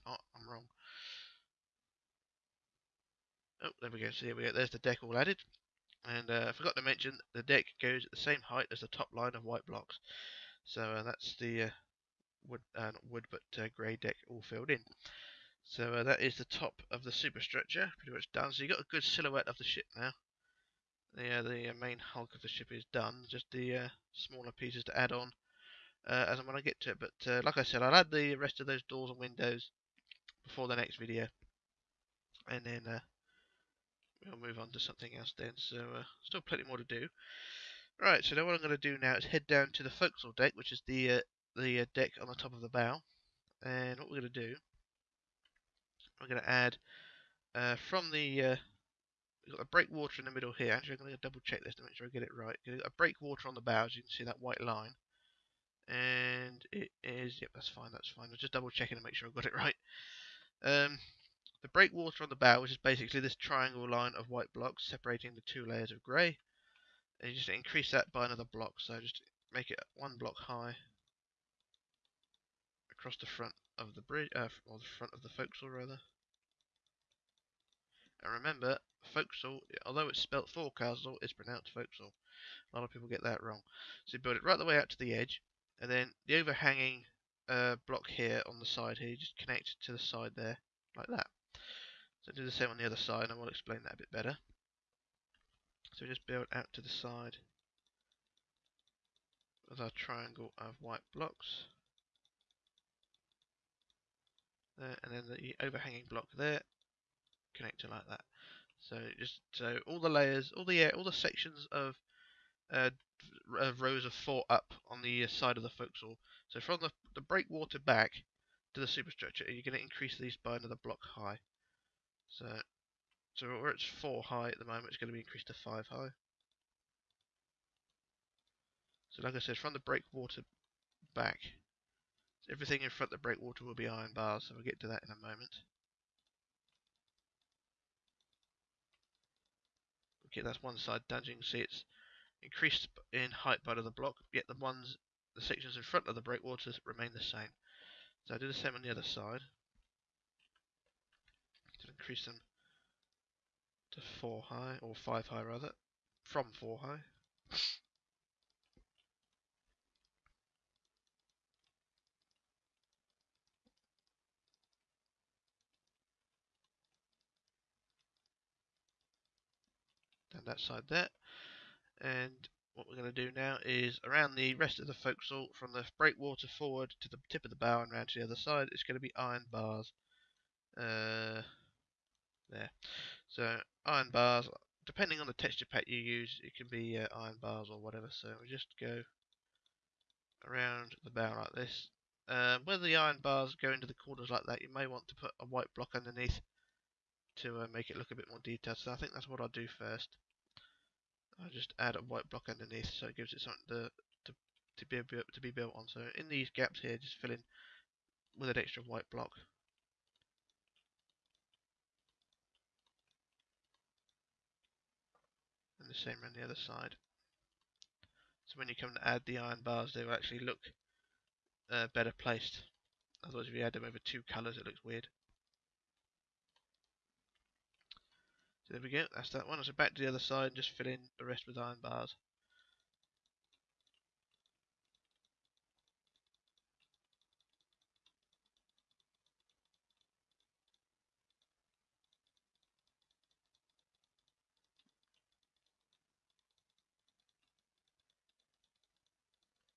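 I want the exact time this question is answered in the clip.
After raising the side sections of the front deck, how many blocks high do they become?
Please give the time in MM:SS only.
02:05.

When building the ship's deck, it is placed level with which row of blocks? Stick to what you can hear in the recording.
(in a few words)
Top line of white blocks.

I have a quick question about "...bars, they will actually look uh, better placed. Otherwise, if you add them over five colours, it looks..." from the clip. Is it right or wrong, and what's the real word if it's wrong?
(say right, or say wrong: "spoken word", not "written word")
wrong: "two", not "five".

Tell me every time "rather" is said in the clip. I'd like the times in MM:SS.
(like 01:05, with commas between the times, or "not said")
01:15, 02:35.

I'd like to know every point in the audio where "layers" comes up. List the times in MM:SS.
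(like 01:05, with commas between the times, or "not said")
01:05, 01:50.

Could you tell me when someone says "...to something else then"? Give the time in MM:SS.
00:34.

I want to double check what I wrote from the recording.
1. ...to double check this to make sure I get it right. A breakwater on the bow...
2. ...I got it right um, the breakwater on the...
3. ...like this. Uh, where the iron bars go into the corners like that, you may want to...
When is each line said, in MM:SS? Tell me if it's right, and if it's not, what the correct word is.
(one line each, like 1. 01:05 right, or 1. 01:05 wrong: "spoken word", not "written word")
1. 00:51 right
2. 00:59 right
3. 03:11 right.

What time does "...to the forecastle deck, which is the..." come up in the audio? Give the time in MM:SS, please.
00:39.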